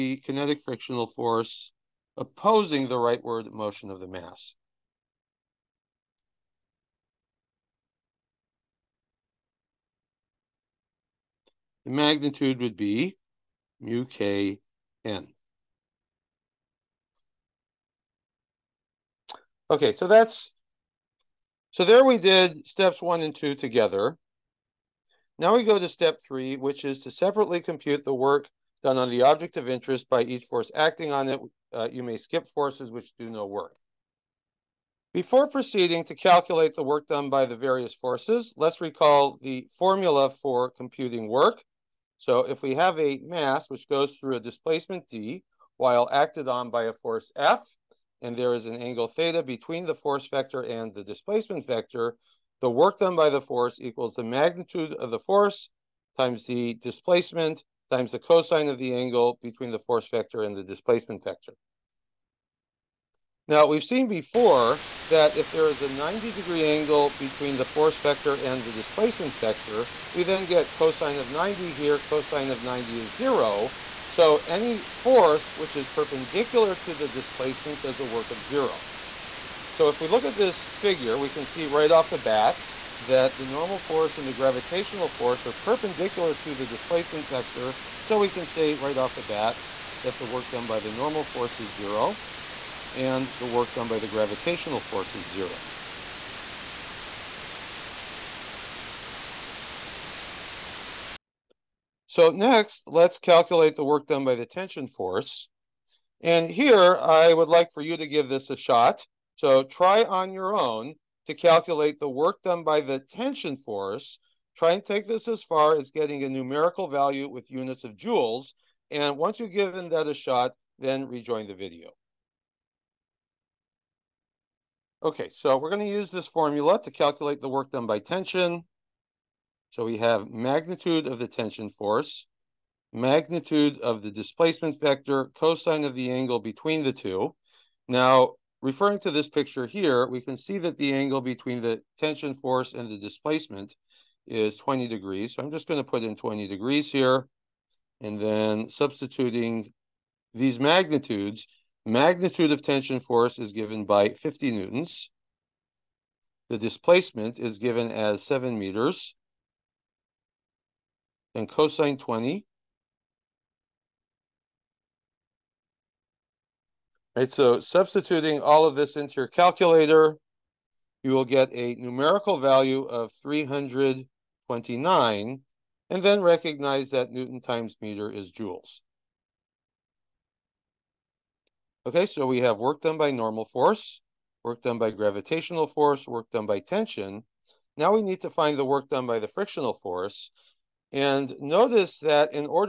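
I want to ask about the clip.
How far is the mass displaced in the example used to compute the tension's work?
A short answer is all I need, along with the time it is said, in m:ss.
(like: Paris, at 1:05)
7 meters, at 2:38.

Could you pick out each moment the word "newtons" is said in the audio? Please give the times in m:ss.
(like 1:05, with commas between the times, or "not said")
2:34, 2:57.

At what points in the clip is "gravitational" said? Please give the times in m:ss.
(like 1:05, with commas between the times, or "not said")
1:24, 1:34, 3:04.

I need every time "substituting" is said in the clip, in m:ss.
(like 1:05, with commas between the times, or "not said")
2:28, 2:47.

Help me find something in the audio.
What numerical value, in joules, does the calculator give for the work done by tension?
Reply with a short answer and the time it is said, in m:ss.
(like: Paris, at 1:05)
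329, at 2:53.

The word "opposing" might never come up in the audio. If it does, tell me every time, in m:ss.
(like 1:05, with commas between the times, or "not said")
0:02.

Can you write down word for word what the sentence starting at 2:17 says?
Now, Referring to this picture here, we can see that the angle between the tension force and the displacement is 20 degrees.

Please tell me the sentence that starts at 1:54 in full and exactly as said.
Try and take this as far as getting a numerical value with units of joules.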